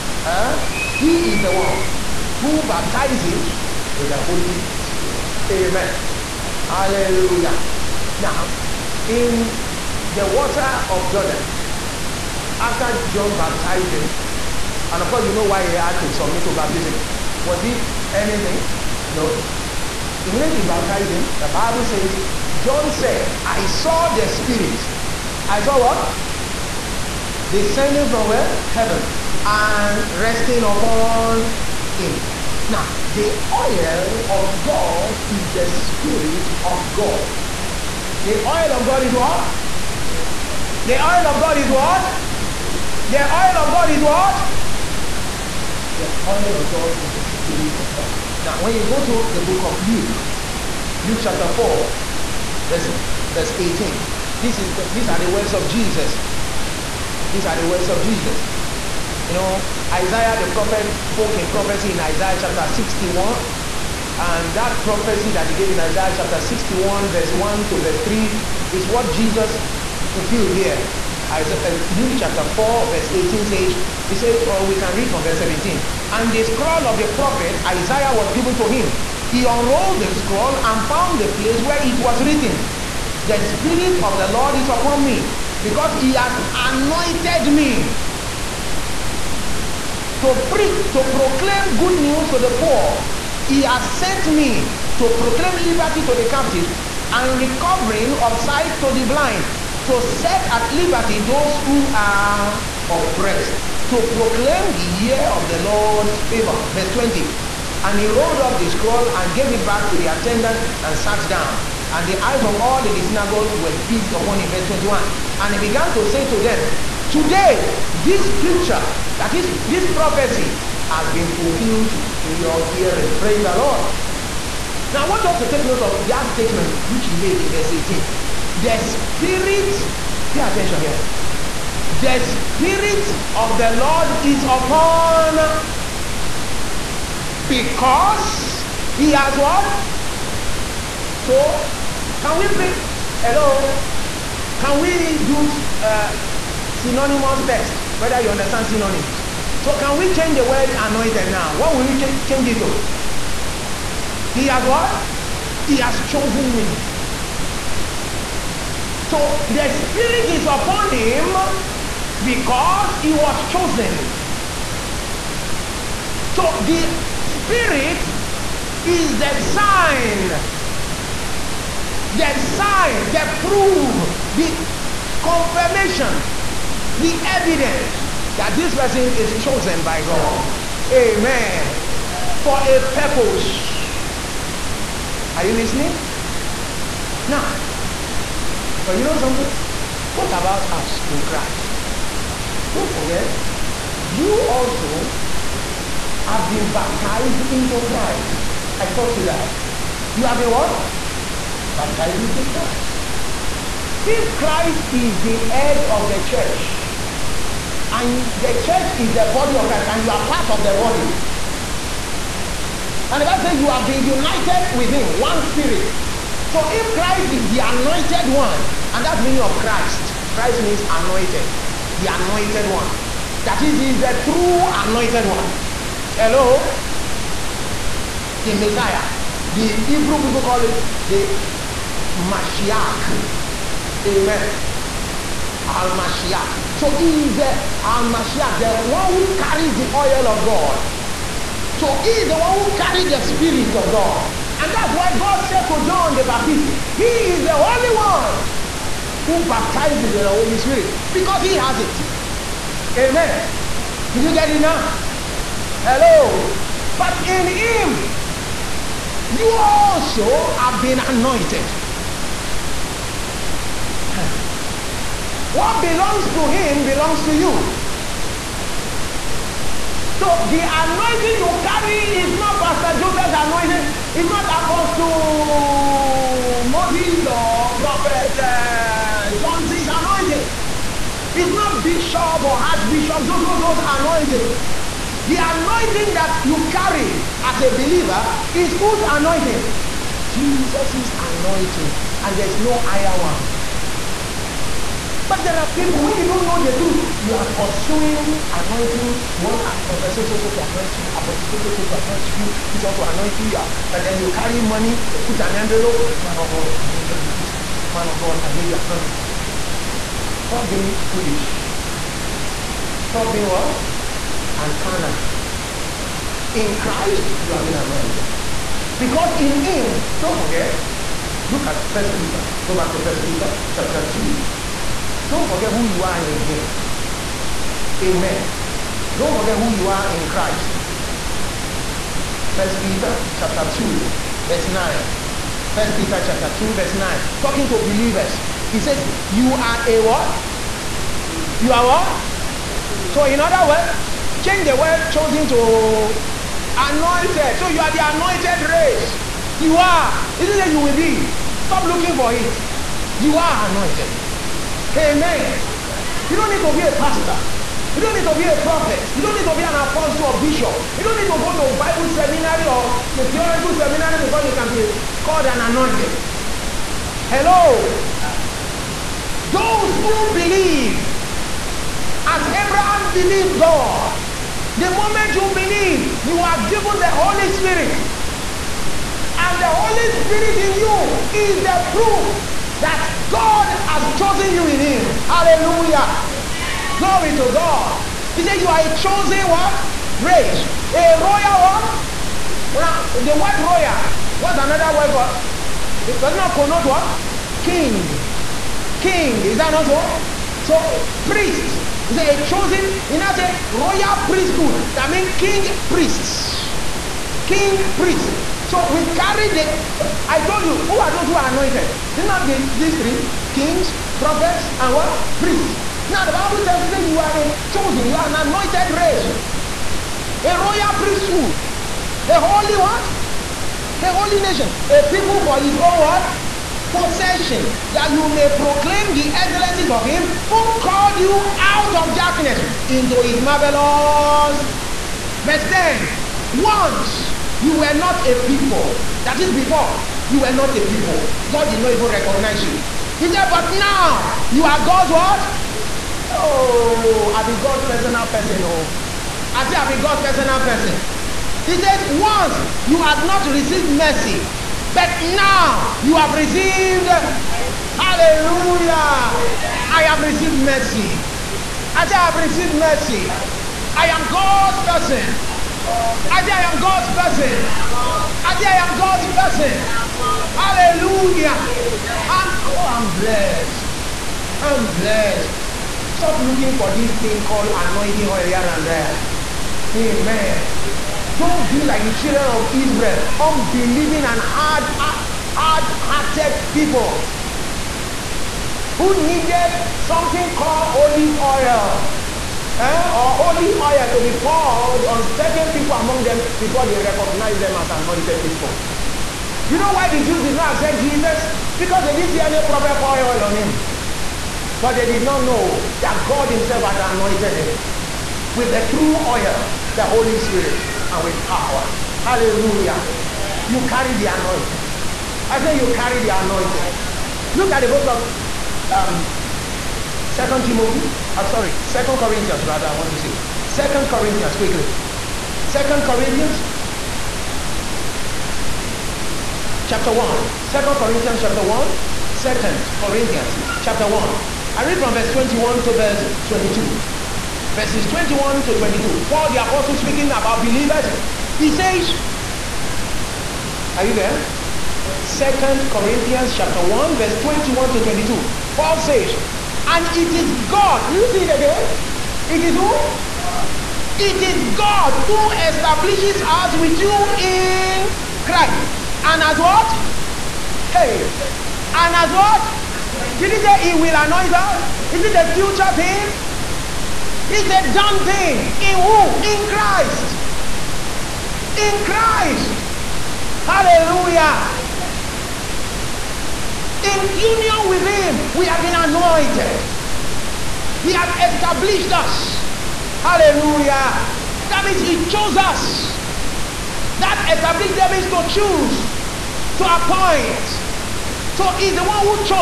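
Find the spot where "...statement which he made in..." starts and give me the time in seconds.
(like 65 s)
126 s.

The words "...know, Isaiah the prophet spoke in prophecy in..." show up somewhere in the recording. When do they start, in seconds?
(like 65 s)
59 s.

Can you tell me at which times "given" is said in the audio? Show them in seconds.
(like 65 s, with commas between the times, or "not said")
78 s, 376 s.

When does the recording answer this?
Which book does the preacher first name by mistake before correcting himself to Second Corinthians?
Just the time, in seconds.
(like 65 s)
520 s.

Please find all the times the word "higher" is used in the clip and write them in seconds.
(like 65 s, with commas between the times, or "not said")
292 s.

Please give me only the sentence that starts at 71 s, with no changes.
Uh, Luke chapter 4, verse 18 says, He says, or we can read from verse 17.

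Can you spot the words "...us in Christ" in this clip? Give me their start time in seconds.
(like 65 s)
190 s.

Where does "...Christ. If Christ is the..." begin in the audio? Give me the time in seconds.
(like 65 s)
202 s.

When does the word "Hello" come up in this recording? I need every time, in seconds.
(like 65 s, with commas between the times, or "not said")
143 s, 226 s, 255 s, 367 s.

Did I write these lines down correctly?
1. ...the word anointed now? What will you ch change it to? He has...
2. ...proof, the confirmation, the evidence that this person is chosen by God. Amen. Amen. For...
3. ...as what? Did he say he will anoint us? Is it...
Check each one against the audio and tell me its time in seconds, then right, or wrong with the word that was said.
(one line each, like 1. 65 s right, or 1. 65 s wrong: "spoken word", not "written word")
1. 150 s right
2. 173 s right
3. 562 s right.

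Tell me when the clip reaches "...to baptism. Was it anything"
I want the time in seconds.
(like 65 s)
16 s.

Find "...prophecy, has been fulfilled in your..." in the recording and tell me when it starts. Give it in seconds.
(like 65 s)
119 s.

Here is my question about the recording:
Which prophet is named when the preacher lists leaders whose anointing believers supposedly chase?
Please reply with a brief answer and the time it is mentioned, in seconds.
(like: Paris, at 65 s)
Johnson, at 277 s.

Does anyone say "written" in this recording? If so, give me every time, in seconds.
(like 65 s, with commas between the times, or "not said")
82 s.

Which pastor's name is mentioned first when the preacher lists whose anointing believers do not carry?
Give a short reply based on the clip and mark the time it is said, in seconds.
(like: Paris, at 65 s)
Pastor Joseph, at 272 s.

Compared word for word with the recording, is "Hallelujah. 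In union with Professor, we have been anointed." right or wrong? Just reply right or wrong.
wrong.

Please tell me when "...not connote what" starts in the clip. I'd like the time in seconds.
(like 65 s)
396 s.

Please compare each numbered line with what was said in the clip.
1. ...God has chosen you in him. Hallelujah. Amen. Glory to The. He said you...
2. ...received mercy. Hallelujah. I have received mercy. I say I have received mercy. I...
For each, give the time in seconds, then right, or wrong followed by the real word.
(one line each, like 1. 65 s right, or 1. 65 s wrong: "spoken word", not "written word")
1. 383 s wrong: "God", not "The"
2. 456 s right.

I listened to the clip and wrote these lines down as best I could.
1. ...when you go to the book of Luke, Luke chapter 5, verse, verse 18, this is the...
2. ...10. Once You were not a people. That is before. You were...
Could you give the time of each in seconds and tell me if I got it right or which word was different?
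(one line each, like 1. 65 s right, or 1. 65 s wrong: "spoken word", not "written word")
1. 48 s wrong: "4", not "5"
2. 435 s right.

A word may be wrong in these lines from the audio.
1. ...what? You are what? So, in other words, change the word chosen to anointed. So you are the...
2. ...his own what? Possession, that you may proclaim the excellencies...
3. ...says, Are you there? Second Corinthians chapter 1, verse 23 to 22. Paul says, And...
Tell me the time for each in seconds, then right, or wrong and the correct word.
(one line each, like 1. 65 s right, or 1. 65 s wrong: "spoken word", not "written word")
1. 340 s right
2. 425 s right
3. 541 s wrong: "21", not "23".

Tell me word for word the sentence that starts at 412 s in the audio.
It's not this, these three, kings, prophets, and what?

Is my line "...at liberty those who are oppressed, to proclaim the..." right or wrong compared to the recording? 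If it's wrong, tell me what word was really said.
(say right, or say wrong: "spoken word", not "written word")
right.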